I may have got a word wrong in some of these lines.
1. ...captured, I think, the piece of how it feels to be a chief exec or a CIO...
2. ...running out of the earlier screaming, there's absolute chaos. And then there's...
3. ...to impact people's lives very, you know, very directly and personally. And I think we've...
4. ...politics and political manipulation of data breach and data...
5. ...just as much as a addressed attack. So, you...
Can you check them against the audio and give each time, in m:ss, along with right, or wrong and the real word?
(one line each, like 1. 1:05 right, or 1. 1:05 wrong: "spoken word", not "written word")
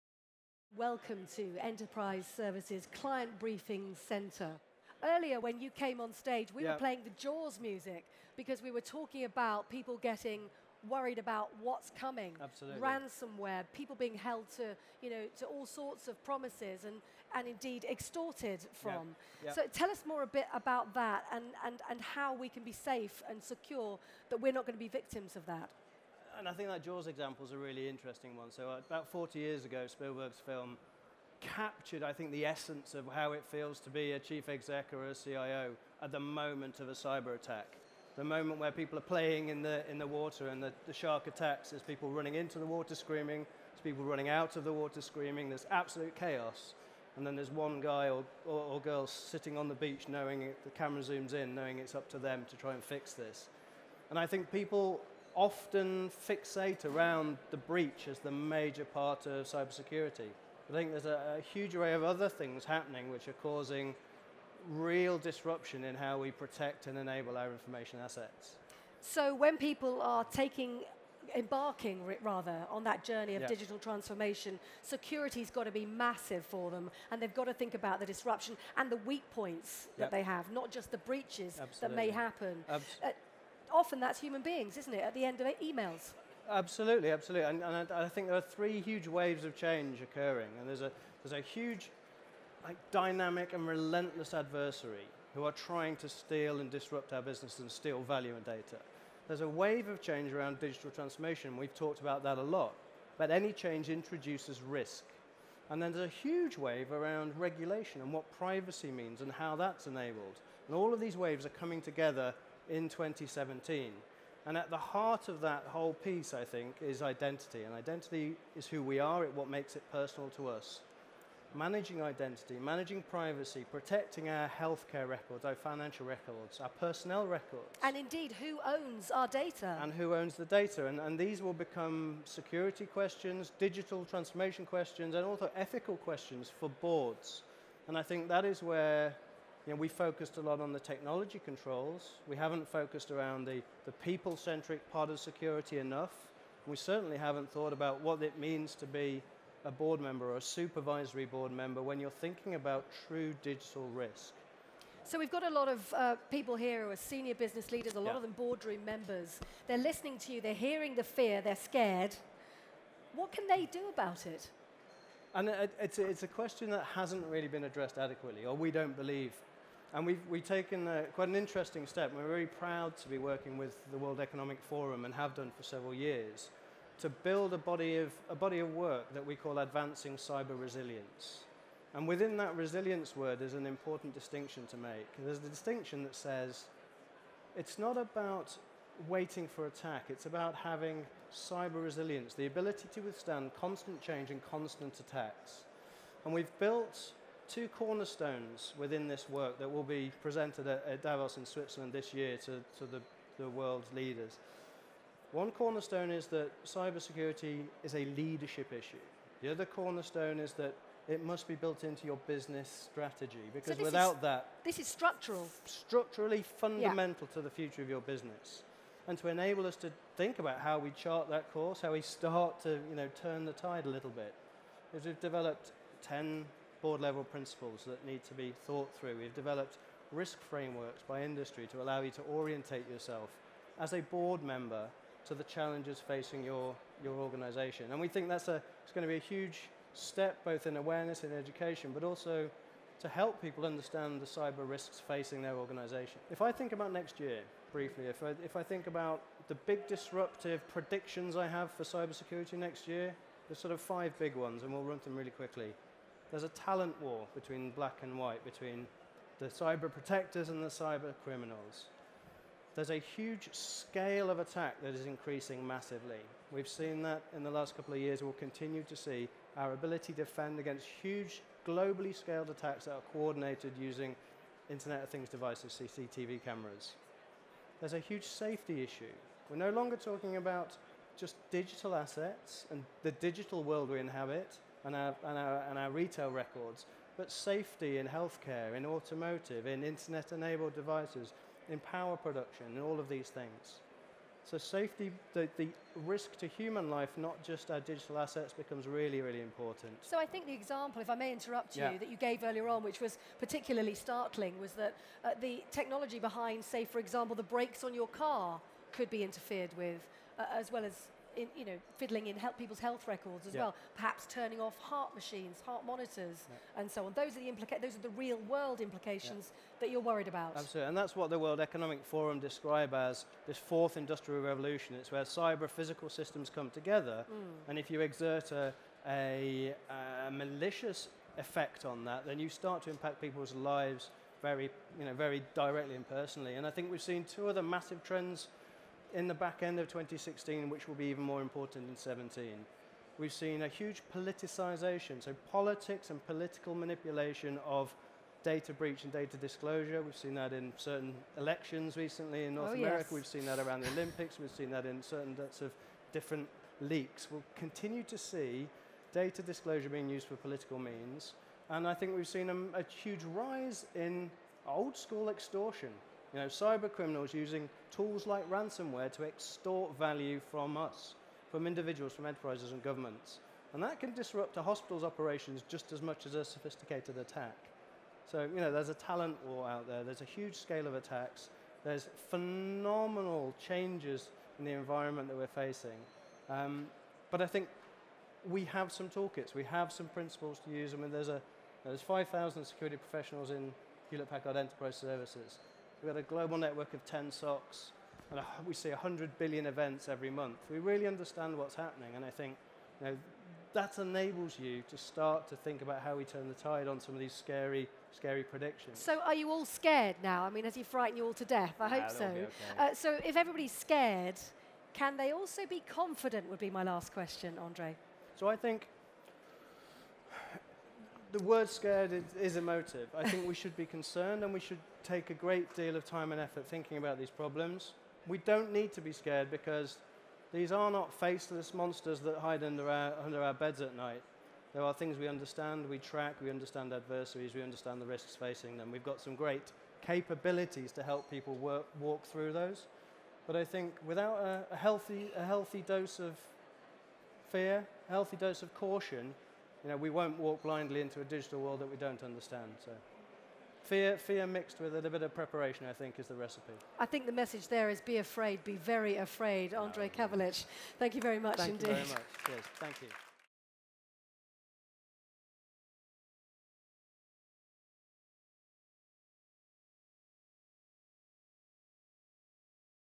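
1. 0:31 wrong: "essence", not "piece"
2. 0:44 wrong: "water", not "earlier"
3. 5:32 right
4. 5:45 right
5. 6:15 wrong: "sophisticated", not "addressed".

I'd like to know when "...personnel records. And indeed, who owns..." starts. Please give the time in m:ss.
2:06.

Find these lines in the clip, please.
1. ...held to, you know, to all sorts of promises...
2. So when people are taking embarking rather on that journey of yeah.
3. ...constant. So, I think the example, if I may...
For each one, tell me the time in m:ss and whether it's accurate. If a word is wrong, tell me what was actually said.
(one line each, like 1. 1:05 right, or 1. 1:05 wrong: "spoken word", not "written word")
1. 0:14 right
2. 1:09 right
3. 4:59 wrong: "important", not "constant".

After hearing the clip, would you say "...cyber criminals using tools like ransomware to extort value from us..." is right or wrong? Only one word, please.
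right.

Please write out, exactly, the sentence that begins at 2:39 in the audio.
They're listening to you, they're hearing the fear, they're scared.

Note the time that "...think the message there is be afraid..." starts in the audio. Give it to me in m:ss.
7:37.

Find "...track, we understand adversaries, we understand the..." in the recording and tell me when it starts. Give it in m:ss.
7:15.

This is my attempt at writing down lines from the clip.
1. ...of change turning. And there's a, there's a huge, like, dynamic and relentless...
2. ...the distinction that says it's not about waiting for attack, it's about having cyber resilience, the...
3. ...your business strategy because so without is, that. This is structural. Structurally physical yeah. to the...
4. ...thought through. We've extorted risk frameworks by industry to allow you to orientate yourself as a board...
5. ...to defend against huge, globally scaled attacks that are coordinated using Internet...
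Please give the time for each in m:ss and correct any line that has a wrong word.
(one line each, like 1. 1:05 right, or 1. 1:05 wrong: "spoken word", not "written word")
1. 1:29 wrong: "occurring", not "turning"
2. 3:05 right
3. 3:32 wrong: "fundamental", not "physical"
4. 3:48 wrong: "developed", not "extorted"
5. 4:30 right.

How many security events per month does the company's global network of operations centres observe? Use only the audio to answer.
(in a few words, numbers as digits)
100 billion.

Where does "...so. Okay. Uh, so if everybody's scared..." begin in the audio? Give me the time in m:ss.
6:52.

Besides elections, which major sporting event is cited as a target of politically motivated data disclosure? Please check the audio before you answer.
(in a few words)
the Olympics.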